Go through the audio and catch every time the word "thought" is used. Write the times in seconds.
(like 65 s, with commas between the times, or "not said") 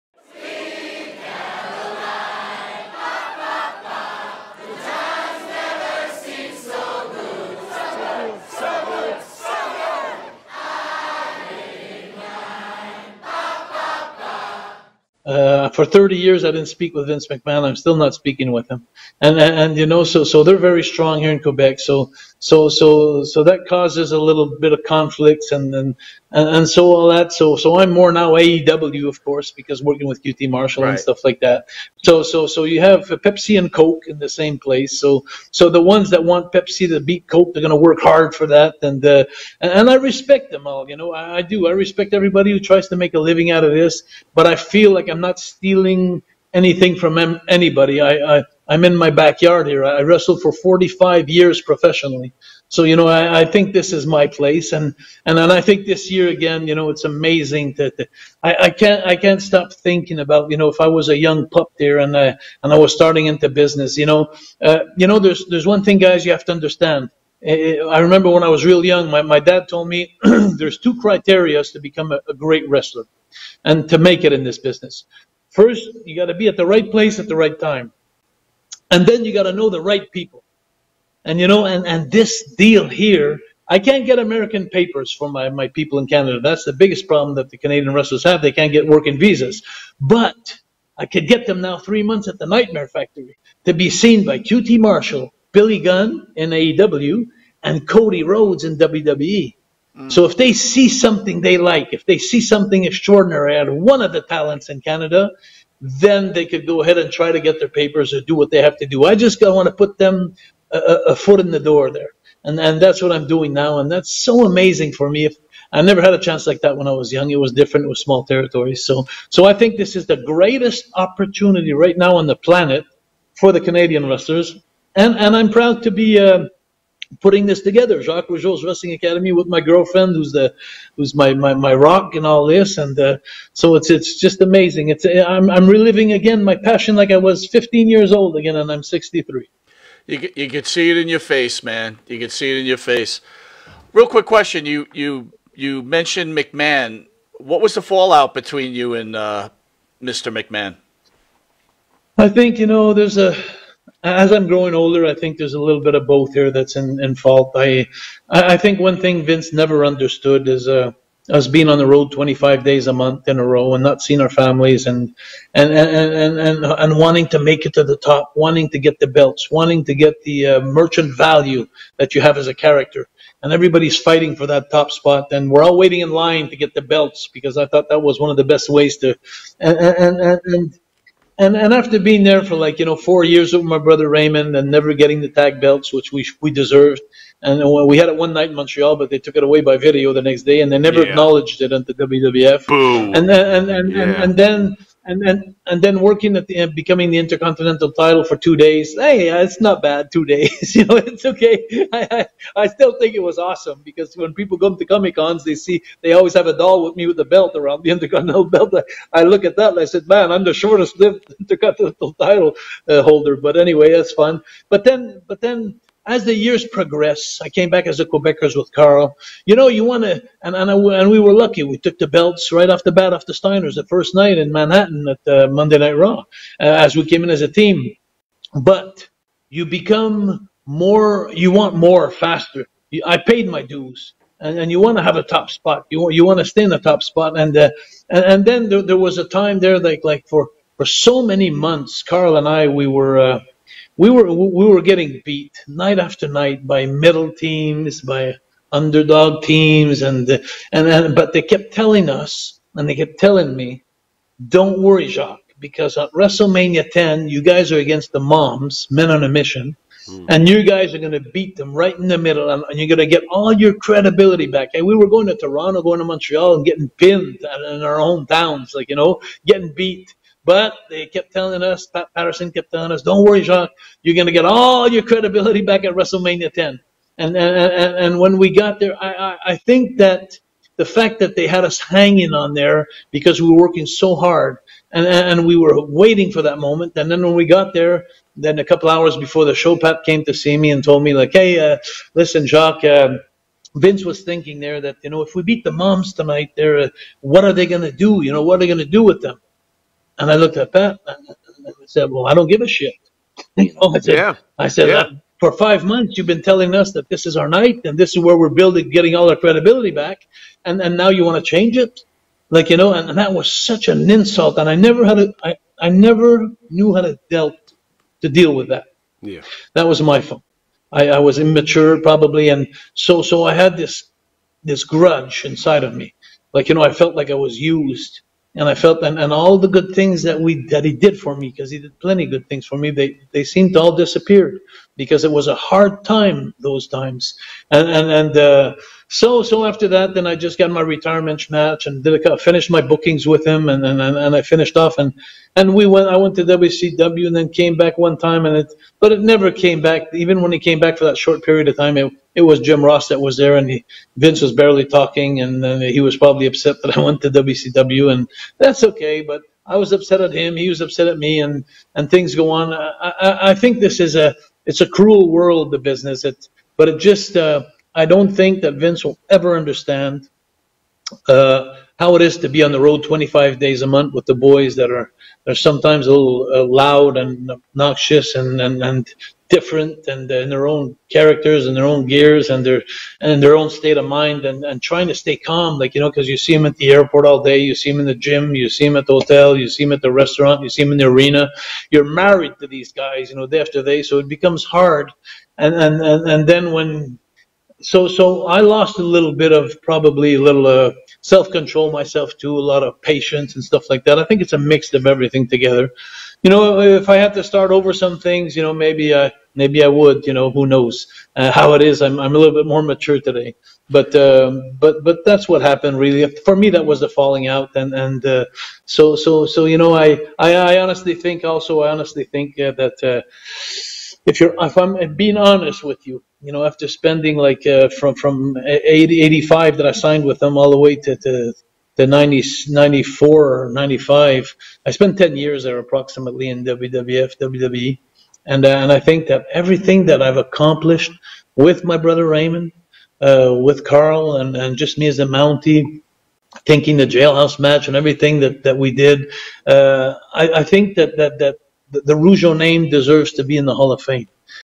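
177 s.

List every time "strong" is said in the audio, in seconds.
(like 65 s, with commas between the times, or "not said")
20 s.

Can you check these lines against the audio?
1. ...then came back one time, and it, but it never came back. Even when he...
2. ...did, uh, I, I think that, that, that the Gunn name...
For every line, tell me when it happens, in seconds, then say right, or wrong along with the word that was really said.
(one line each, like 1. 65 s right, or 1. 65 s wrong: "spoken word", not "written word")
1. 347 s right
2. 448 s wrong: "Rougeau", not "Gunn".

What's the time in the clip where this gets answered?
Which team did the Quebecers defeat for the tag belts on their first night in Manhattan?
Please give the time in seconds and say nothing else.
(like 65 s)
223 s.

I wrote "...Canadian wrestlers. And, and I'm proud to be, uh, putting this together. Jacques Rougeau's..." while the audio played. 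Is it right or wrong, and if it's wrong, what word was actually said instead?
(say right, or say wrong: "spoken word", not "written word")
right.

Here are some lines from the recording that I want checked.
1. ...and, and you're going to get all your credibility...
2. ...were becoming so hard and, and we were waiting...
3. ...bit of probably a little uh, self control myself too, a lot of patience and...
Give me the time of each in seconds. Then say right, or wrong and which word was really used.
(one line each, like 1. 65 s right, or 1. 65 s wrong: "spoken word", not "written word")
1. 262 s right
2. 283 s wrong: "working", not "becoming"
3. 399 s right.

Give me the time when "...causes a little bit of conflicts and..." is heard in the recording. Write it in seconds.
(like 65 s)
23 s.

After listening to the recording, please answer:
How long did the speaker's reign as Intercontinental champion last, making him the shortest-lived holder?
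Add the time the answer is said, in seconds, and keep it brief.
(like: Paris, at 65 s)
2 days, at 198 s.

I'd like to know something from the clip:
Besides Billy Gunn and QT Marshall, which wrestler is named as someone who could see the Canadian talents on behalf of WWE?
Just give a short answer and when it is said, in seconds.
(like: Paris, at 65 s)
Cody Rhodes, at 97 s.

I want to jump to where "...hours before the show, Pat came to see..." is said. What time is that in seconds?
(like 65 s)
288 s.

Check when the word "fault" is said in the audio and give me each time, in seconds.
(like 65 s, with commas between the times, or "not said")
157 s, 320 s.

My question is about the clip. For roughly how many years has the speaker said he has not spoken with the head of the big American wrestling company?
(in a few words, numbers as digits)
30.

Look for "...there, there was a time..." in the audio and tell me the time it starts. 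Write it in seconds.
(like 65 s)
238 s.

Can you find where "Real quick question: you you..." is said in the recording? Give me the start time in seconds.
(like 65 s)
143 s.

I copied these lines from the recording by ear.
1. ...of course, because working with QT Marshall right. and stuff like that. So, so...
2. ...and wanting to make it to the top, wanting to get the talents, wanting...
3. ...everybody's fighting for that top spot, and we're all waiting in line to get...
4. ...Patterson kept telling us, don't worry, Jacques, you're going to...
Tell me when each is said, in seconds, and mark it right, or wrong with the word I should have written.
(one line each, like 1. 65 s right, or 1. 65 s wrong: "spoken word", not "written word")
1. 29 s right
2. 166 s wrong: "belts", not "talents"
3. 173 s right
4. 272 s right.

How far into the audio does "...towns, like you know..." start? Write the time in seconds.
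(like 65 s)
268 s.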